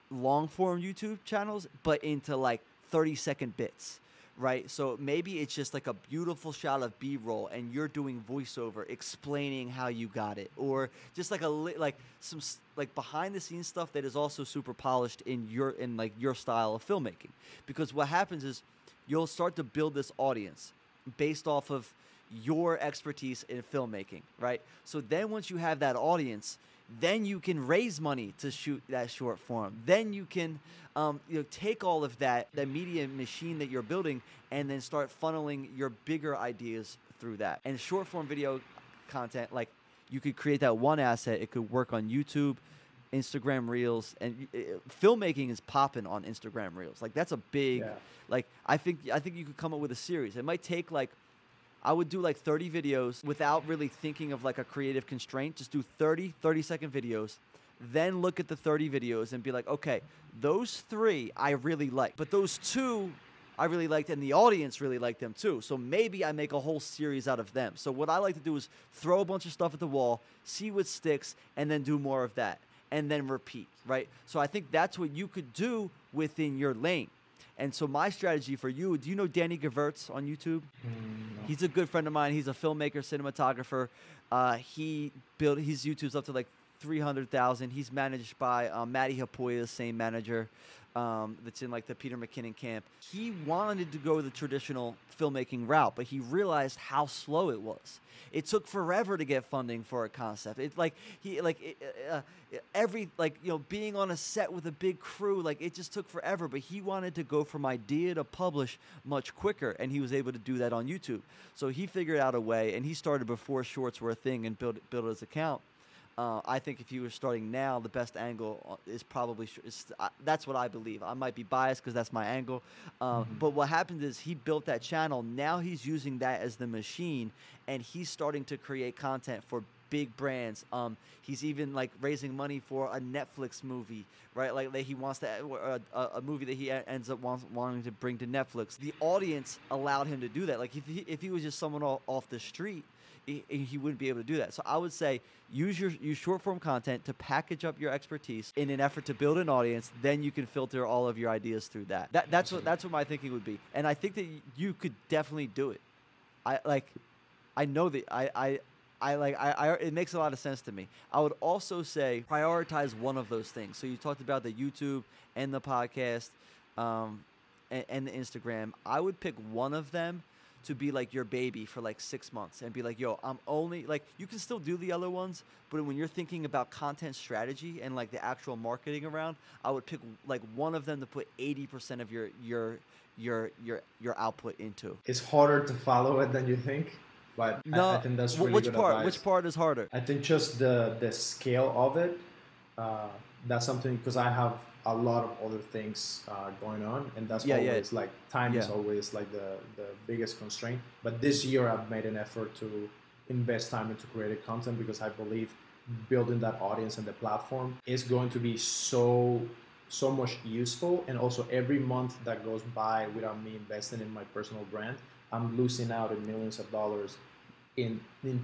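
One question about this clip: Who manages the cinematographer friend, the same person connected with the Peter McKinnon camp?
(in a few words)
Matti Haapoja.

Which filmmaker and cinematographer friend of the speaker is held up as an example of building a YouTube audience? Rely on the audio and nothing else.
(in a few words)
Danny Gevirtz.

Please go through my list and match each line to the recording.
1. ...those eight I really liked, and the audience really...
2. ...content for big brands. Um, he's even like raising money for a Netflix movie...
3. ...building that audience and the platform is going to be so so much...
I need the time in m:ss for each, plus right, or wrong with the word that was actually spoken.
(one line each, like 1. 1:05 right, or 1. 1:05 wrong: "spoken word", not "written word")
1. 1:02 wrong: "two", not "eight"
2. 2:08 right
3. 3:26 right.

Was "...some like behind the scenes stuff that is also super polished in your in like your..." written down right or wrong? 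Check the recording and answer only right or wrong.
right.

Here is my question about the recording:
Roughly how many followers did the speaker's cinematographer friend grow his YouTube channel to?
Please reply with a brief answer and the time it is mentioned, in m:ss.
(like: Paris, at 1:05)
300,000, at 1:26.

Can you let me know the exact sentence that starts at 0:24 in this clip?
So then once you have that audience, then you can raise money to shoot that short form.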